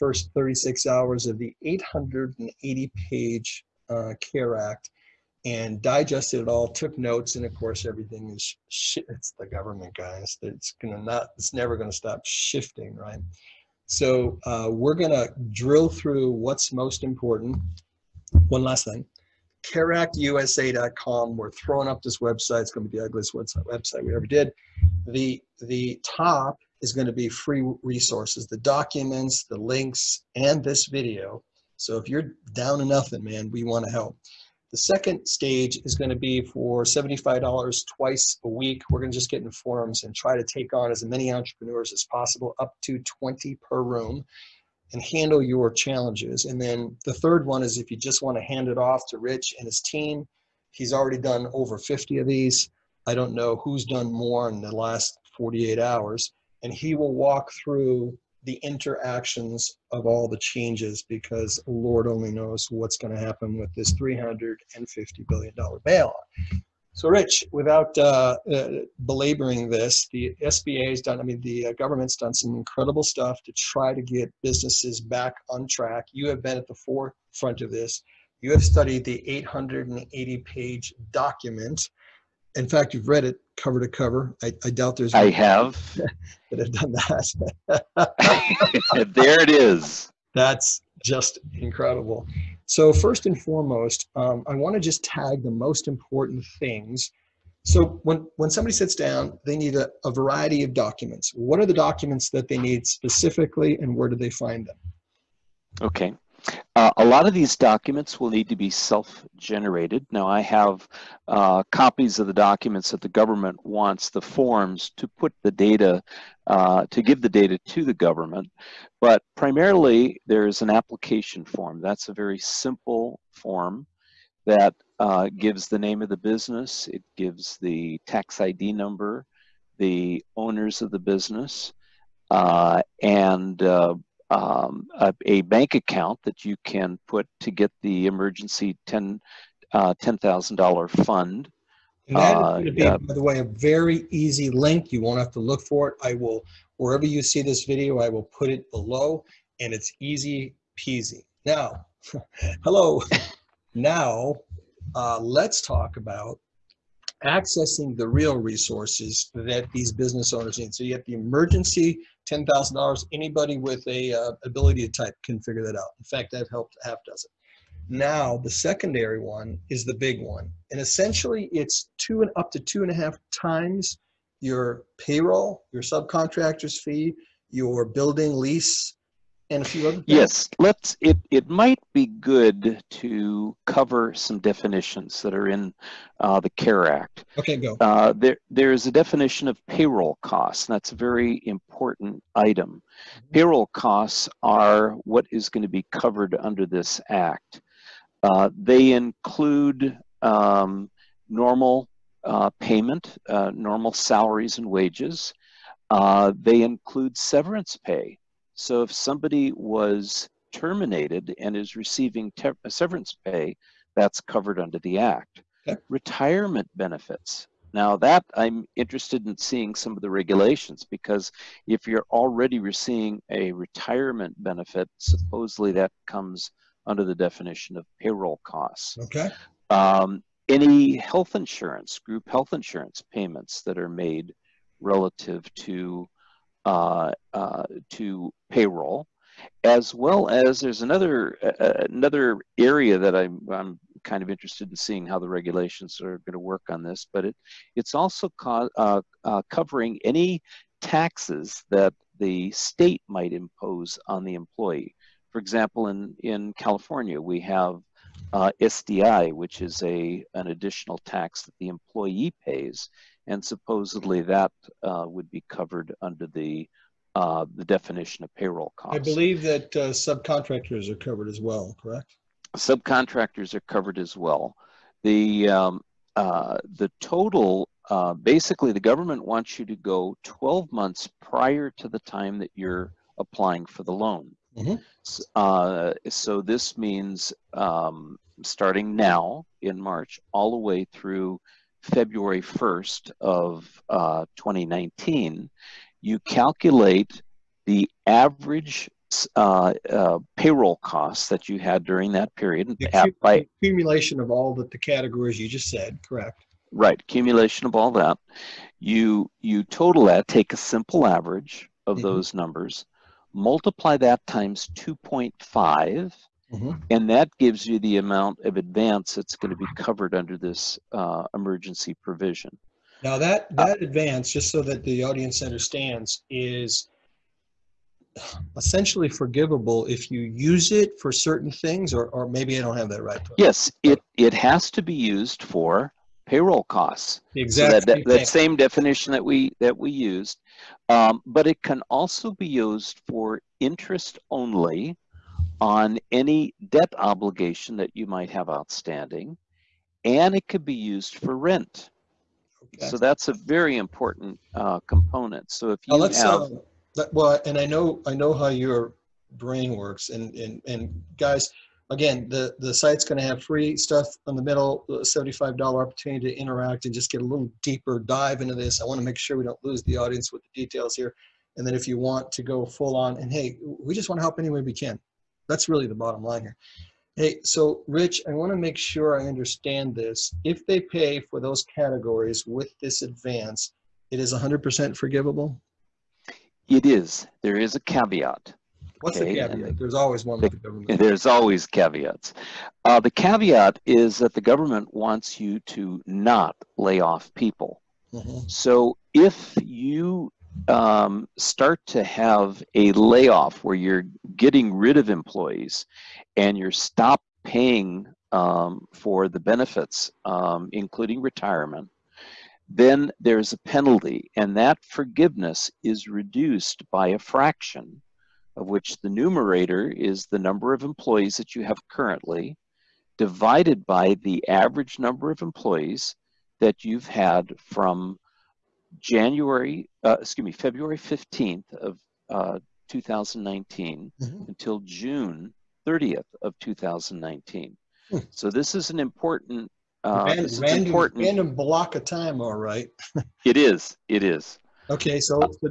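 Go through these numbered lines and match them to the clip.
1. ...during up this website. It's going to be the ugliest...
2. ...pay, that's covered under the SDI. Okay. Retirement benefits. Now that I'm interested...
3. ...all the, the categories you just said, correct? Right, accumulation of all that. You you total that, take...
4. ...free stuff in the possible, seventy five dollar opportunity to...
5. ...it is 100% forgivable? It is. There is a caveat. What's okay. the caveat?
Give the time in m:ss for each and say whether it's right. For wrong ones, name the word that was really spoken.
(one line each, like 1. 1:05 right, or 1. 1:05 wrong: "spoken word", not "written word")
1. 0:21 wrong: "throwing", not "during"
2. 3:33 wrong: "Act", not "SDI"
3. 5:04 right
4. 6:03 wrong: "middle", not "possible"
5. 6:24 right.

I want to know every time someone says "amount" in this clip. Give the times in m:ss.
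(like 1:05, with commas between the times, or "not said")
5:17.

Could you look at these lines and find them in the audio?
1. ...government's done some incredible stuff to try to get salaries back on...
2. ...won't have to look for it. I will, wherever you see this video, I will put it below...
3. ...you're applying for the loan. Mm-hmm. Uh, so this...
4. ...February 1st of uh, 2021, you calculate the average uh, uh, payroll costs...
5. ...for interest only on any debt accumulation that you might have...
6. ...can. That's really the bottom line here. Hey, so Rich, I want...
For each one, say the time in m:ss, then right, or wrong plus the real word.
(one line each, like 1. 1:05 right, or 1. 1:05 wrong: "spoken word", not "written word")
1. 1:11 wrong: "businesses", not "salaries"
2. 2:25 right
3. 4:42 right
4. 4:51 wrong: "2019", not "2021"
5. 5:43 wrong: "obligation", not "accumulation"
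6. 6:14 right.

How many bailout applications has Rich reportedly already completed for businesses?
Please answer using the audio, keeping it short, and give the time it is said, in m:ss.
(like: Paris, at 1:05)
over 50, at 0:51.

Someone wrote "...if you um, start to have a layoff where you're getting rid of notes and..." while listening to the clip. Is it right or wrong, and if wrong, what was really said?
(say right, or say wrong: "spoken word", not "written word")
wrong: "employees", not "notes".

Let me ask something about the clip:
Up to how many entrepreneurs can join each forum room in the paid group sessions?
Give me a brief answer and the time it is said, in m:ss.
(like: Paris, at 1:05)
20, at 0:42.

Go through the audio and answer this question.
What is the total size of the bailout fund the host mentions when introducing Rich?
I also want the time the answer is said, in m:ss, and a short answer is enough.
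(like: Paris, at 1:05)
$350 billion, at 1:03.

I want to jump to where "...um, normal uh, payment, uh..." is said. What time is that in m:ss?
3:20.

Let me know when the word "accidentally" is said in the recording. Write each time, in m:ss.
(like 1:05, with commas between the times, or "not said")
not said.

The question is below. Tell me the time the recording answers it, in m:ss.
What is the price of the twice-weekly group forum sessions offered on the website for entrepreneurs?
0:36.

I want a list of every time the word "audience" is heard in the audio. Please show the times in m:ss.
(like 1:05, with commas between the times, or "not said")
5:25, 6:09.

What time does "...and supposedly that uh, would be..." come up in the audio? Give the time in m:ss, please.
4:23.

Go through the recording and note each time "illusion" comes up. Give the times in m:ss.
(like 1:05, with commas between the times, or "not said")
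not said.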